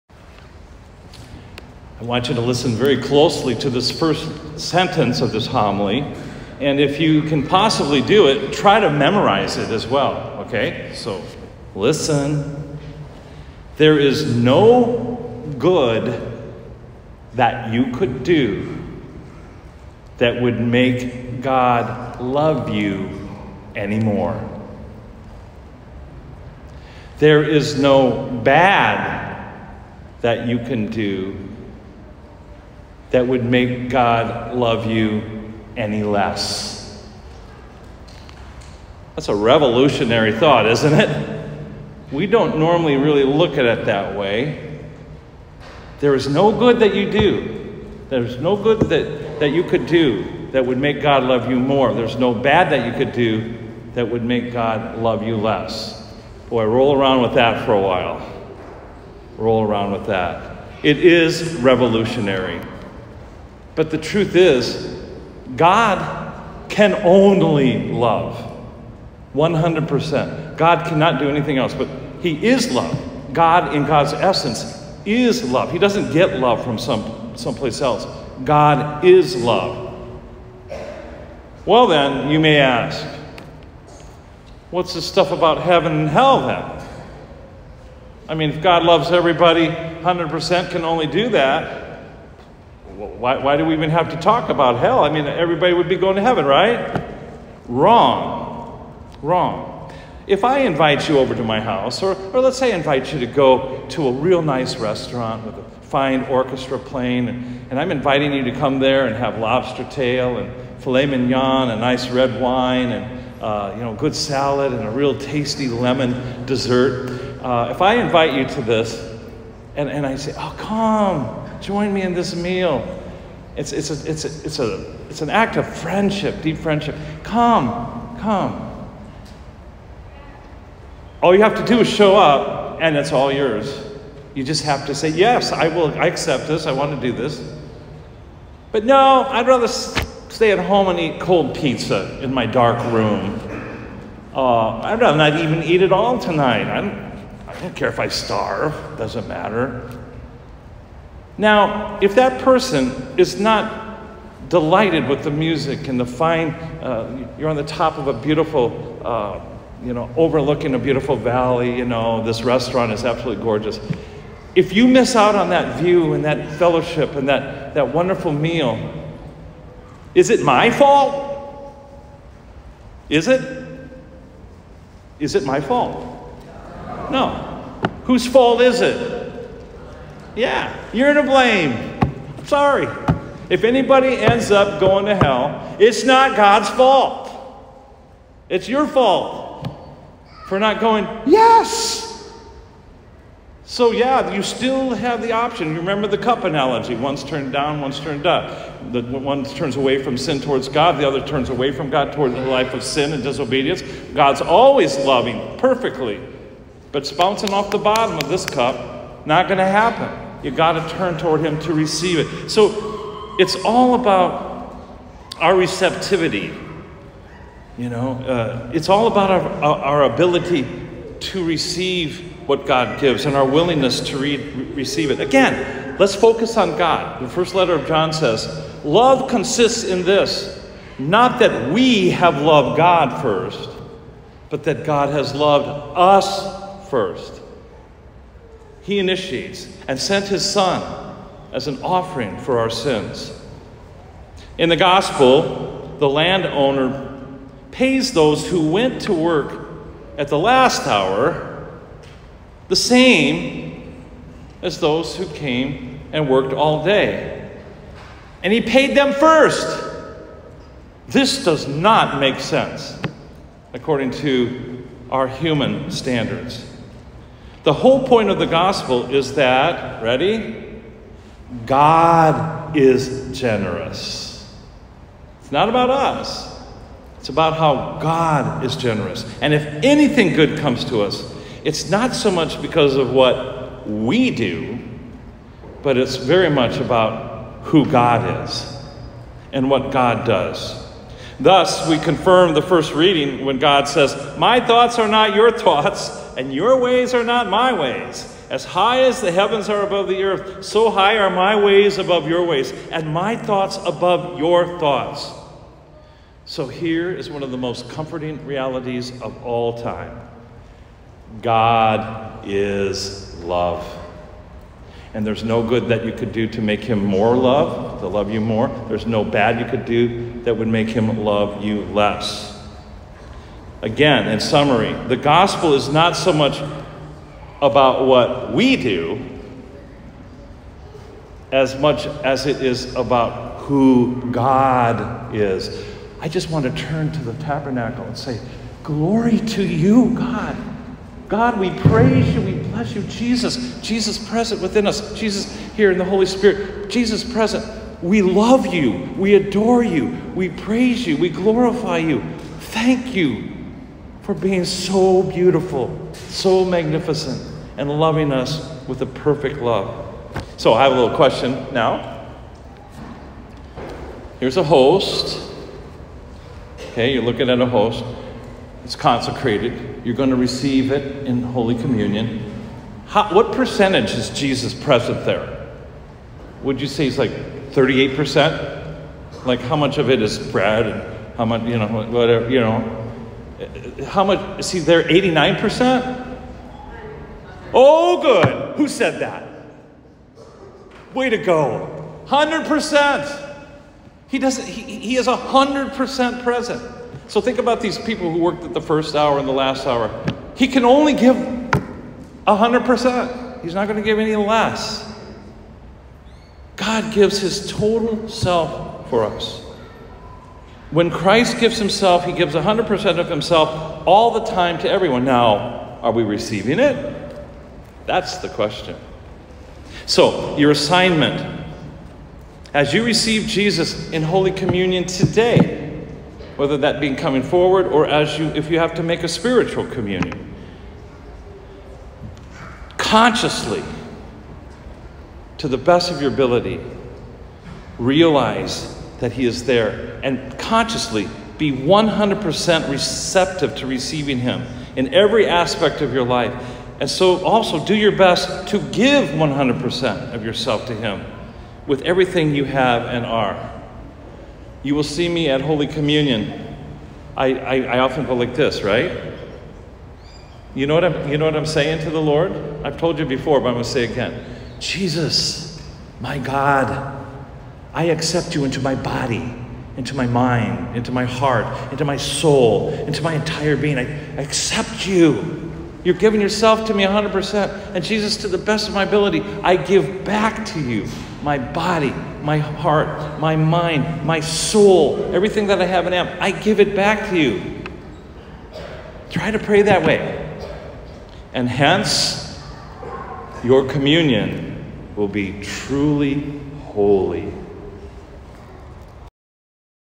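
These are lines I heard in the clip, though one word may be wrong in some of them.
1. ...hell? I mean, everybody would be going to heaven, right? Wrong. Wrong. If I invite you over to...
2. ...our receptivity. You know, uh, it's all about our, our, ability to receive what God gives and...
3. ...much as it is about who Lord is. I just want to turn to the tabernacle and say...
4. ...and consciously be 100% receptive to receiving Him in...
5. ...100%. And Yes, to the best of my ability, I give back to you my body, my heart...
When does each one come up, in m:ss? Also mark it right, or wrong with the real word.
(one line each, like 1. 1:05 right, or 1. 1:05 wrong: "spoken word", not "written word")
1. 1:34 right
2. 3:35 right
3. 5:31 wrong: "God", not "Lord"
4. 7:20 right
5. 7:57 wrong: "Jesus", not "Yes".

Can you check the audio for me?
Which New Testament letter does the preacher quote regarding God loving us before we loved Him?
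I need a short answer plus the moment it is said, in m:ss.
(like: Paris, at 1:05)
first letter of John, at 3:47.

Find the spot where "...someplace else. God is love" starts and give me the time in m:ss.
1:17.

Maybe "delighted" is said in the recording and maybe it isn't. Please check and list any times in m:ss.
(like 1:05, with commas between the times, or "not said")
2:34.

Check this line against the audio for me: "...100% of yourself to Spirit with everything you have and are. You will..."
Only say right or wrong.
wrong.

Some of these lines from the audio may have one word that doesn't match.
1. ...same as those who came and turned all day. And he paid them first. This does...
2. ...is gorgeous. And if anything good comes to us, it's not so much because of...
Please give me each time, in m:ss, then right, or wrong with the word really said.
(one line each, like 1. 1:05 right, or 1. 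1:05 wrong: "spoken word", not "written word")
1. 4:12 wrong: "worked", not "turned"
2. 4:38 wrong: "generous", not "gorgeous".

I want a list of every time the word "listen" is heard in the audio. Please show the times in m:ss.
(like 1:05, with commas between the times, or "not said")
0:02, 0:11.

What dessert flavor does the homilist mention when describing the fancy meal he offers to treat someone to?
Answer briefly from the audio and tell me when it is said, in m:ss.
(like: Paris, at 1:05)
lemon, at 1:55.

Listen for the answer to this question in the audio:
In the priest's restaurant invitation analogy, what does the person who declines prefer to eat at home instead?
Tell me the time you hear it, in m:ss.
2:21.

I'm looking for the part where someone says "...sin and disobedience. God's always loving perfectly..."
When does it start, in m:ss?
3:22.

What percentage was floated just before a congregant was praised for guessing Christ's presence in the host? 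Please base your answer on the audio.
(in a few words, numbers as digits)
89%.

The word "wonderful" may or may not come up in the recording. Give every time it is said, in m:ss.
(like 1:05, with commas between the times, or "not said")
2:47.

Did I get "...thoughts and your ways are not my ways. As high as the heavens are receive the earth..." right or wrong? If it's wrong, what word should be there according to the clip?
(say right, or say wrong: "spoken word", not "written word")
wrong: "above", not "receive".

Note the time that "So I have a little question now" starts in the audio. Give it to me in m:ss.
6:00.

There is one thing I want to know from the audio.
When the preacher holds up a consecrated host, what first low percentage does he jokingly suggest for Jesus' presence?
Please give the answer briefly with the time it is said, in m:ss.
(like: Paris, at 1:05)
38%, at 6:17.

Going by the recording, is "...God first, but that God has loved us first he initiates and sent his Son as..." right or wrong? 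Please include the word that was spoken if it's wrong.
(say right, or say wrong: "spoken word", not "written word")
right.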